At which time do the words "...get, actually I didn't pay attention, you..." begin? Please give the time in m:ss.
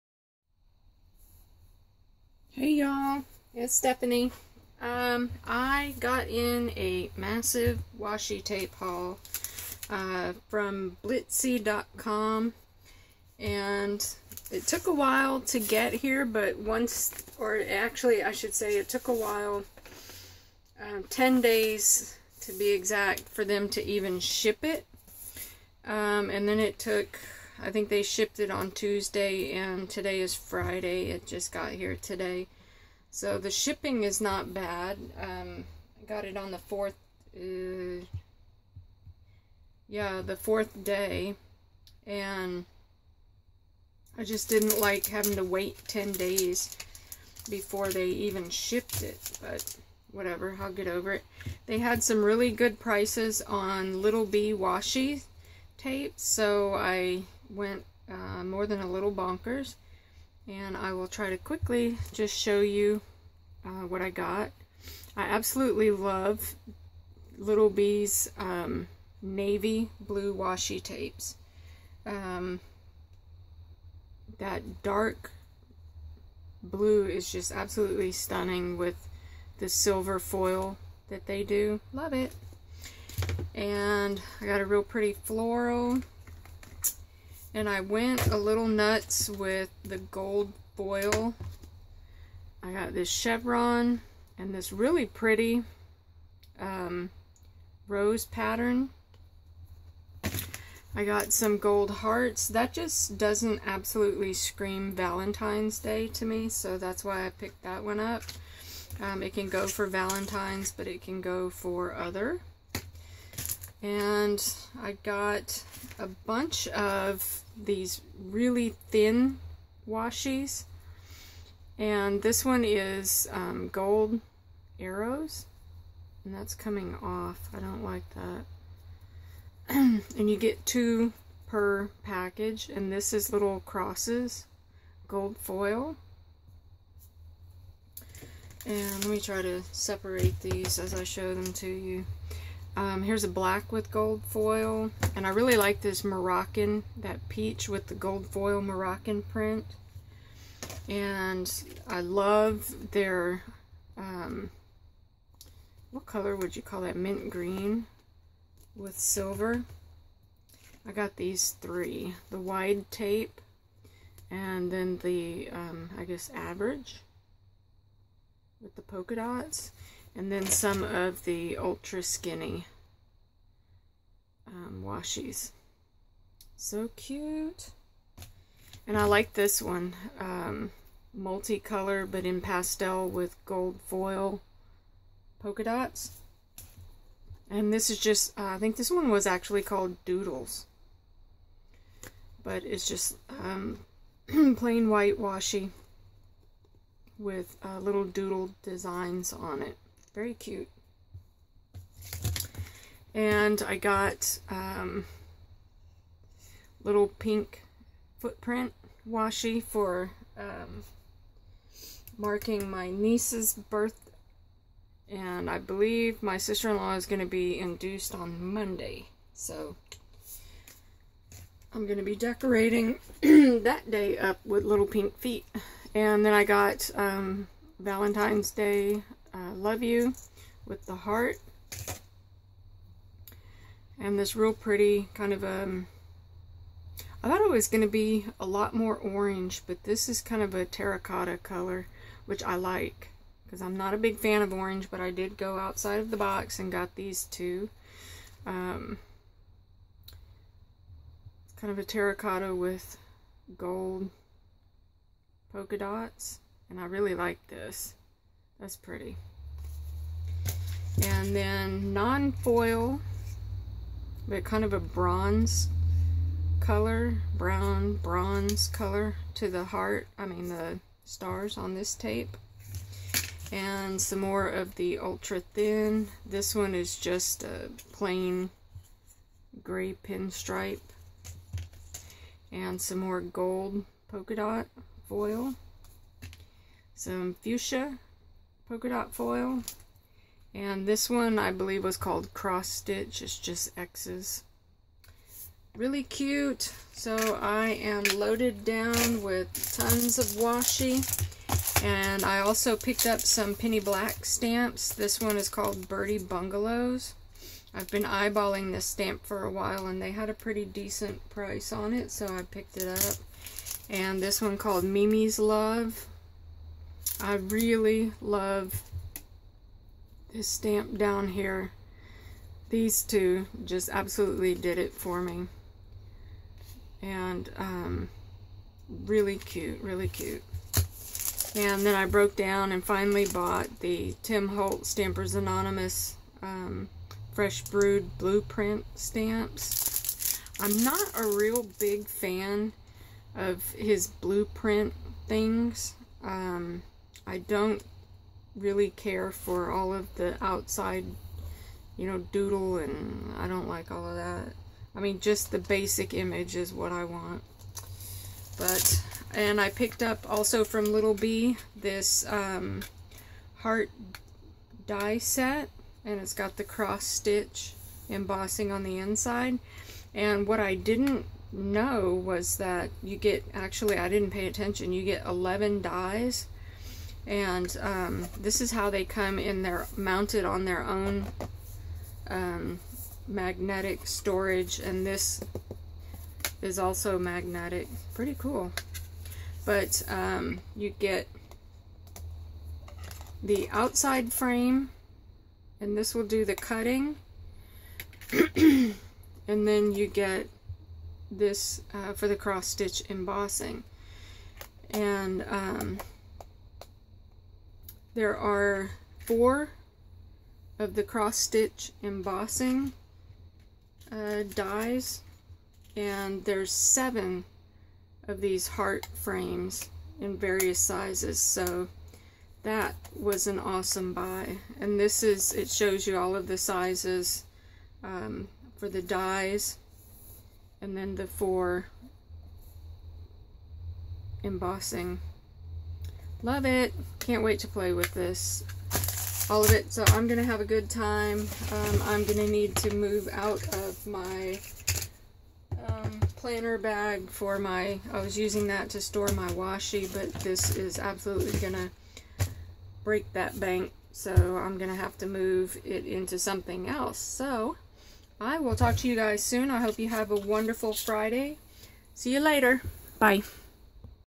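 6:13.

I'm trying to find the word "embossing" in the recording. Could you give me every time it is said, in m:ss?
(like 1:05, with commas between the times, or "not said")
6:08, 6:43, 6:52, 7:14.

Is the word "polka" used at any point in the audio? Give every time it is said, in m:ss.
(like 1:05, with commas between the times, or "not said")
2:48, 3:05, 4:15, 4:44, 4:48.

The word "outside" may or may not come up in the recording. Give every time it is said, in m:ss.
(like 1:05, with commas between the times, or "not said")
4:05, 5:50, 6:33.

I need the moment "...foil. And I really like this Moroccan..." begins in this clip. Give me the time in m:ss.
2:24.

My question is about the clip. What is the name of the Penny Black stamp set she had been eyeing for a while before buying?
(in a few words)
Birdie Bungalows.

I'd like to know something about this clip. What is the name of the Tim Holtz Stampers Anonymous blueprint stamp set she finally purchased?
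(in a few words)
Fresh Brewed.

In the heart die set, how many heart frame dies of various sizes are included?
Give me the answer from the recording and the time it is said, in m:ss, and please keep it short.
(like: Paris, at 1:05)
7, at 6:56.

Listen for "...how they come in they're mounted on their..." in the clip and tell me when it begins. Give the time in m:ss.
6:18.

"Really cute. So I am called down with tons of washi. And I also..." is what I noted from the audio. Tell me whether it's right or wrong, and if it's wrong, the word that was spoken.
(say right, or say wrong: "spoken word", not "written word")
wrong: "loaded", not "called".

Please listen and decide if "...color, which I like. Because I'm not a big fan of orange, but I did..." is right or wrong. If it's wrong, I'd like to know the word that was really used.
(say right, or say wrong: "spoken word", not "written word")
right.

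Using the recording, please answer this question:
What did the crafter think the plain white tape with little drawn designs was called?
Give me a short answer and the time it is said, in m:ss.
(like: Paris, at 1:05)
Doodles, at 3:10.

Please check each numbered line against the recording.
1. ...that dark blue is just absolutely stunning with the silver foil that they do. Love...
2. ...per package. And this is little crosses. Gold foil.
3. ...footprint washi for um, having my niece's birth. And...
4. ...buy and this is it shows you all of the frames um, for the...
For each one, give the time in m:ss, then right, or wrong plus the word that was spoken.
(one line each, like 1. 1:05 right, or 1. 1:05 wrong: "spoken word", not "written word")
1. 1:14 right
2. 2:11 right
3. 3:28 wrong: "marking", not "having"
4. 7:04 wrong: "sizes", not "frames".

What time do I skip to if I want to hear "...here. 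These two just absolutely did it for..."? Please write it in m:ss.
5:21.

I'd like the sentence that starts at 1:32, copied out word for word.
I got this chevron and this really pretty um, rose pattern.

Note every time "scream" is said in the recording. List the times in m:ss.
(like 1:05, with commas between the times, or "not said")
1:44.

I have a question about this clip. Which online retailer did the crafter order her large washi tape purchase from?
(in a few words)
Blitsy.com.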